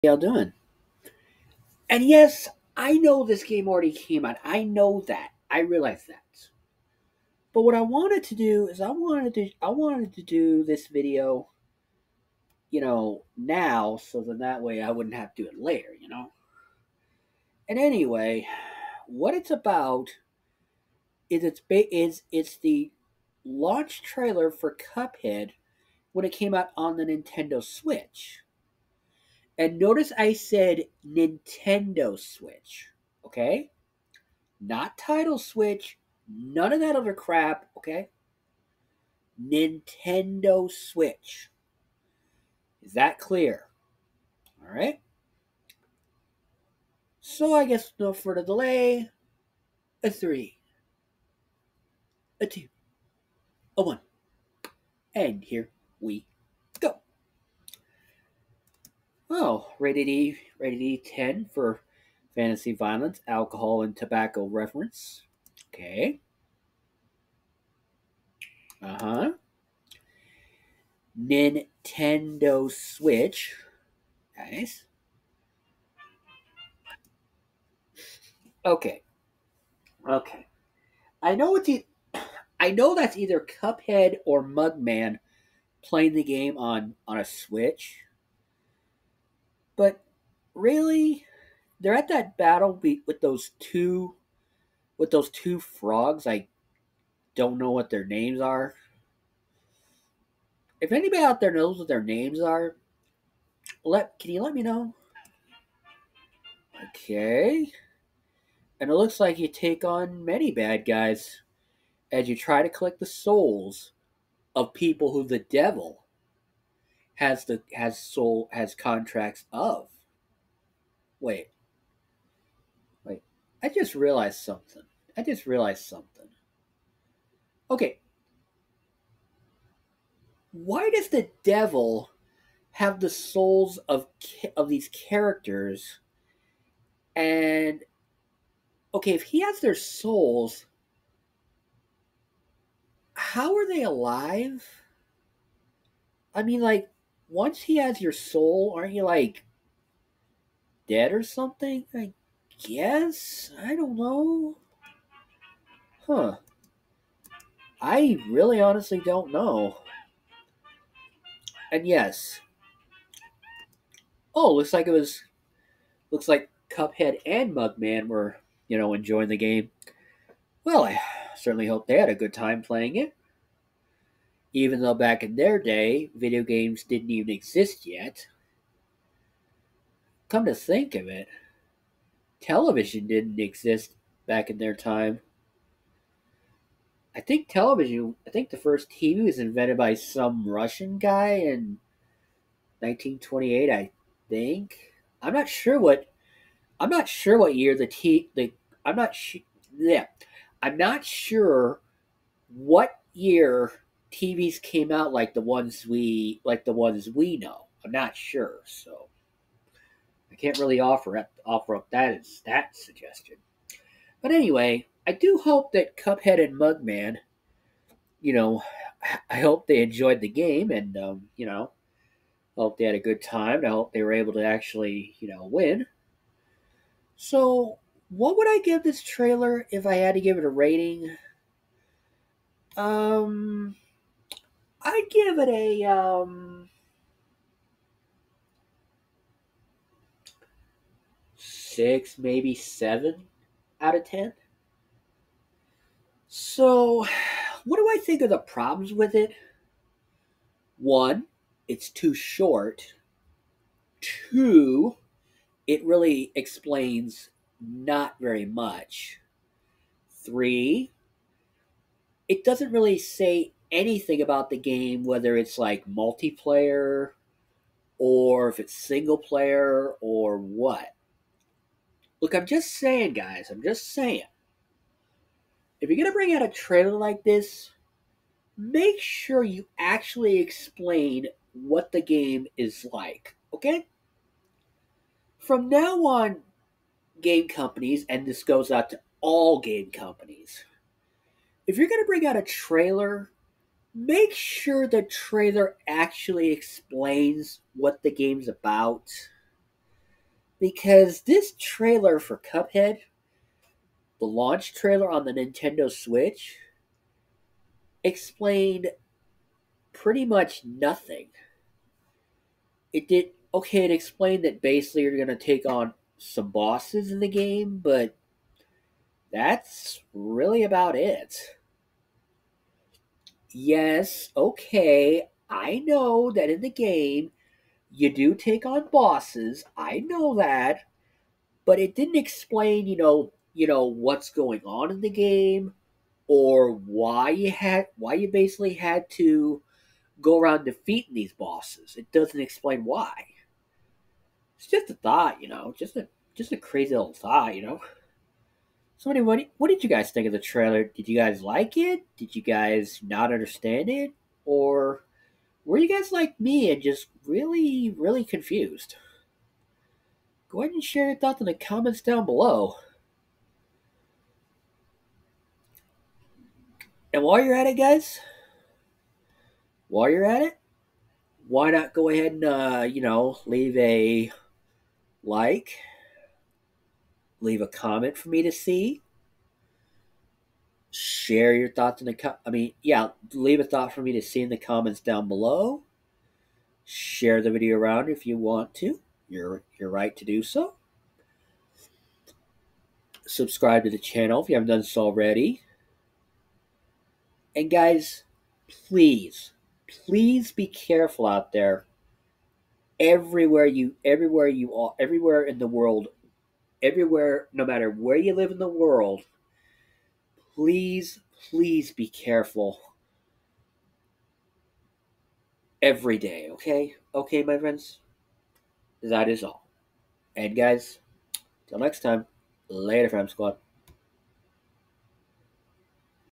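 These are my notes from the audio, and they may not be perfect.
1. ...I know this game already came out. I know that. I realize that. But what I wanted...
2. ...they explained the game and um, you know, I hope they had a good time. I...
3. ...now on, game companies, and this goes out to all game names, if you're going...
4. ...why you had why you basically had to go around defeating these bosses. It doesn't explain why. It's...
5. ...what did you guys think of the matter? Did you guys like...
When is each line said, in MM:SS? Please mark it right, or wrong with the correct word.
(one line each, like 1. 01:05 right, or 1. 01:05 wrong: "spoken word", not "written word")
1. 00:02 right
2. 03:39 wrong: "enjoyed", not "explained"
3. 04:45 wrong: "companies", not "names"
4. 05:36 right
5. 05:49 wrong: "trailer", not "matter".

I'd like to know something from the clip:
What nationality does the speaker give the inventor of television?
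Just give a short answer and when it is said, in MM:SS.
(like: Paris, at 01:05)
Russian, at 03:10.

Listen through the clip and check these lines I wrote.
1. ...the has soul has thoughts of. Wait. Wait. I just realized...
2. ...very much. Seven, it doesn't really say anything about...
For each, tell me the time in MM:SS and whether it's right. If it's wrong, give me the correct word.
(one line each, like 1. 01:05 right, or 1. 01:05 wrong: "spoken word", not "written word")
1. 01:57 wrong: "contracts", not "thoughts"
2. 04:18 wrong: "Three", not "Seven".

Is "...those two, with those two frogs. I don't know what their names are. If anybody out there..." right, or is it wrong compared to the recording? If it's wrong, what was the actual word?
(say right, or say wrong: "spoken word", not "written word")
right.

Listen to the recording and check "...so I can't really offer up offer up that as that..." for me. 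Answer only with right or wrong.
right.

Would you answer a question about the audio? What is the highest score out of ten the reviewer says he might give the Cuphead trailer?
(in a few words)
7.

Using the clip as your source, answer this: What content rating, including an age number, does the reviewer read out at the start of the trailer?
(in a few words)
E10.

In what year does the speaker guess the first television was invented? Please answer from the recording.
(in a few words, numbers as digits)
1928.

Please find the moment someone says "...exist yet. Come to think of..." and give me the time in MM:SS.
02:57.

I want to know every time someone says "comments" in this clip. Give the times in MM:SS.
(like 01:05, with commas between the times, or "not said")
06:01, 06:17, 06:24.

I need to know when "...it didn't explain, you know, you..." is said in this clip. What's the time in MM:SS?
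05:31.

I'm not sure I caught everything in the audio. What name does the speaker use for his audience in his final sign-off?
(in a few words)
fam squad.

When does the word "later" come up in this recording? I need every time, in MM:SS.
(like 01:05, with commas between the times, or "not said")
00:15, 07:02.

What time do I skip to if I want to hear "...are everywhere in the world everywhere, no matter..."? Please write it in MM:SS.
06:44.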